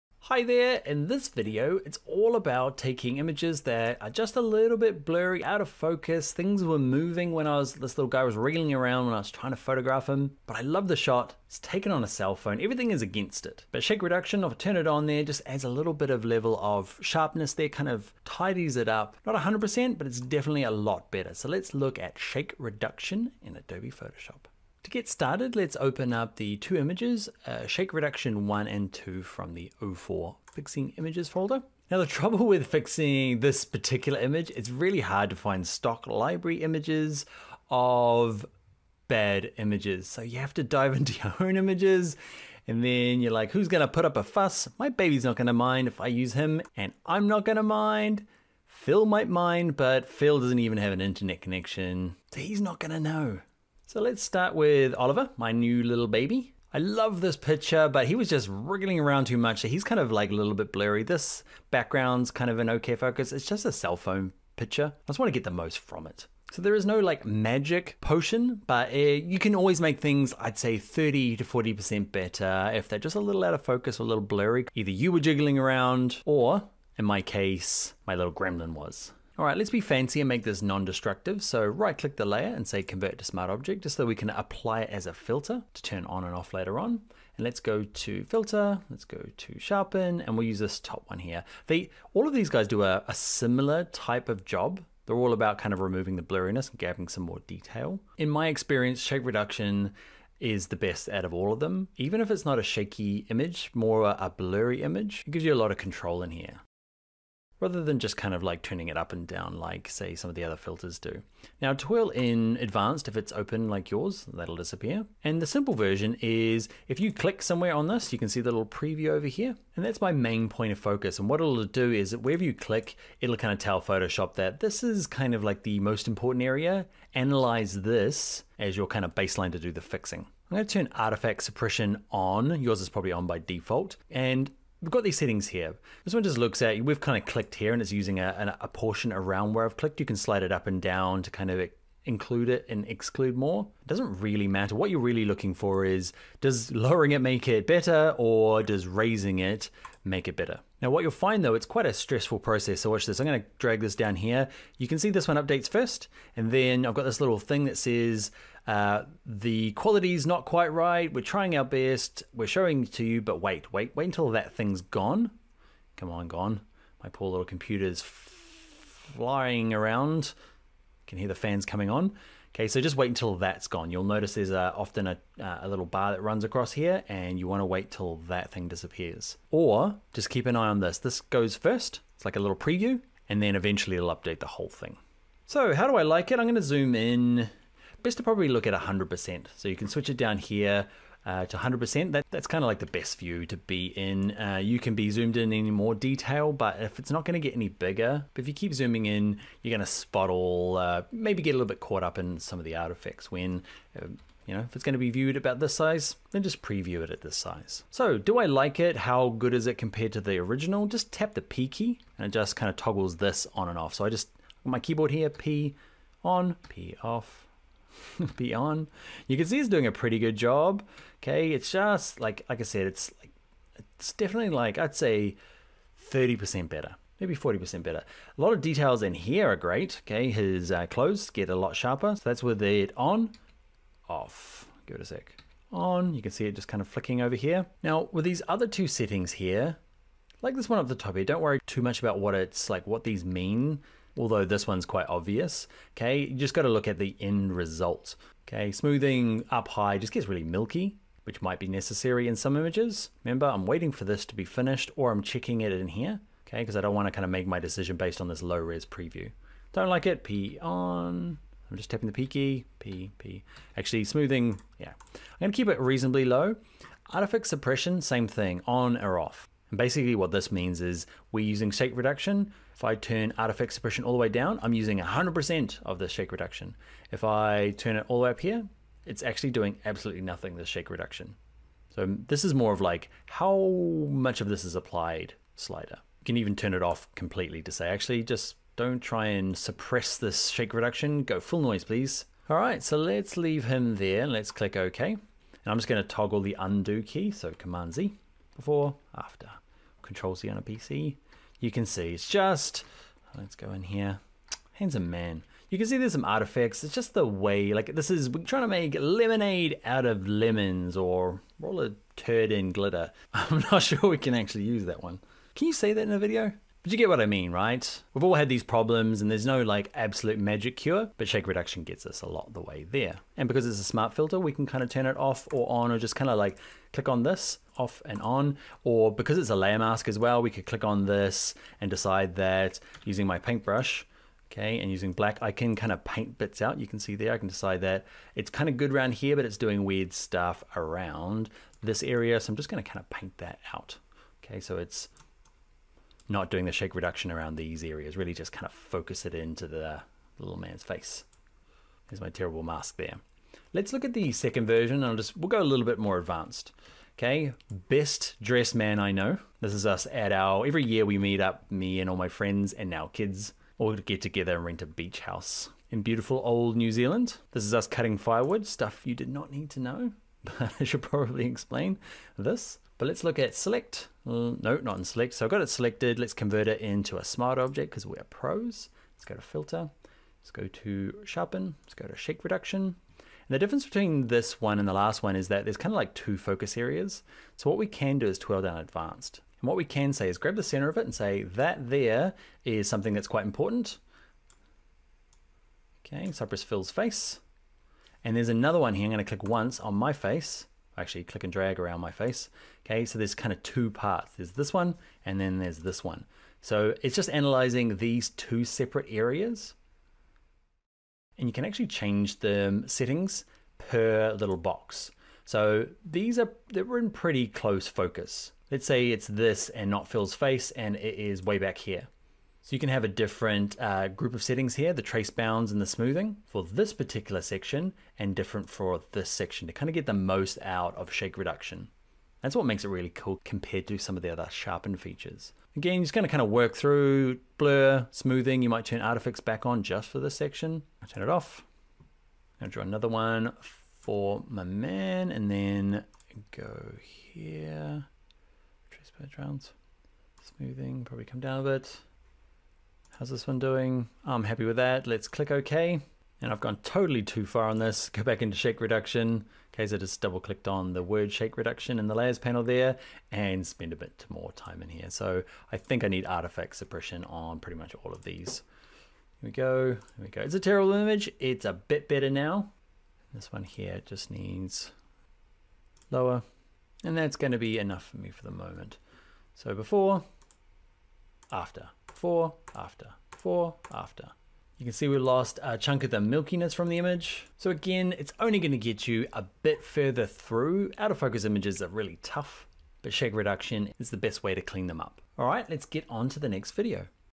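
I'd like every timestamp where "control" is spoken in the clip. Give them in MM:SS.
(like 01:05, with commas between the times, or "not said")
01:45, 05:00.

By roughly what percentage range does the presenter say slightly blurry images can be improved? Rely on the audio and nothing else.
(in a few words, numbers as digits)
30 to 40%.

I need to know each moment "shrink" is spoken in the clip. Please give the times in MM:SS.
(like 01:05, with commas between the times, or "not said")
not said.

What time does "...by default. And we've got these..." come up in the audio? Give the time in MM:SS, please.
02:13.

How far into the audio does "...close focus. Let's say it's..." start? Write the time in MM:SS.
06:57.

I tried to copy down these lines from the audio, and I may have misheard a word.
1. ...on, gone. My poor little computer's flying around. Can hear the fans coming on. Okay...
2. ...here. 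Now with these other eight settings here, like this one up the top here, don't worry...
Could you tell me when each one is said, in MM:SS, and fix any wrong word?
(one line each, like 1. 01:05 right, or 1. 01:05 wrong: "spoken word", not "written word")
1. 02:46 right
2. 03:57 wrong: "two", not "eight".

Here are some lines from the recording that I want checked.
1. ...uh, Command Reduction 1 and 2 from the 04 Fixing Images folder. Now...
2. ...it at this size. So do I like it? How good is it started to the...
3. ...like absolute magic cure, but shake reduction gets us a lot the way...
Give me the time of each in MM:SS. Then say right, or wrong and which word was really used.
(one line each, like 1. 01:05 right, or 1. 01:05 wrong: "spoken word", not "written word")
1. 00:27 wrong: "Shake", not "Command"
2. 03:27 wrong: "compared", not "started"
3. 05:19 right.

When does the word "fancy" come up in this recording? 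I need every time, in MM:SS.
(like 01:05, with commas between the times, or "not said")
01:19.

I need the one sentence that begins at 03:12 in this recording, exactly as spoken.
That, that's kind of like the best view to be in.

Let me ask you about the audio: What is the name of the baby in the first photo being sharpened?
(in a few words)
Oliver.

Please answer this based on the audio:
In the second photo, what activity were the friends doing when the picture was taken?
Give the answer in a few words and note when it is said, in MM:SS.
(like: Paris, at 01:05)
cutting firewood, at 06:07.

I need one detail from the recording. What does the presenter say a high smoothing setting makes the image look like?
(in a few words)
milky.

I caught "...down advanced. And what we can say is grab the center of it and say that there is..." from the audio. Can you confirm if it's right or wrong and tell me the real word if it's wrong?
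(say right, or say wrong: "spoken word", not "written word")
right.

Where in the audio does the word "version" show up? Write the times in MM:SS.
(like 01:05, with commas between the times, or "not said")
01:55, 05:54.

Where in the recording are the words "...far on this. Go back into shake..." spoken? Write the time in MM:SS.
07:37.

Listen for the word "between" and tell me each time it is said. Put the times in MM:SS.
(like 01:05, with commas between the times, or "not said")
06:23.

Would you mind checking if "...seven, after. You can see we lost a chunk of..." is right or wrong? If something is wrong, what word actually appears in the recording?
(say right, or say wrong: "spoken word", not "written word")
wrong: "four", not "seven".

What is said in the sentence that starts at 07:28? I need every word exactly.
Trace bounds, smoothing, probably come down a bit.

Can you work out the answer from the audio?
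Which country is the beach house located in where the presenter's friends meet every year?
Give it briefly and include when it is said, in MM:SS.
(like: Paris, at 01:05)
New Zealand, at 06:06.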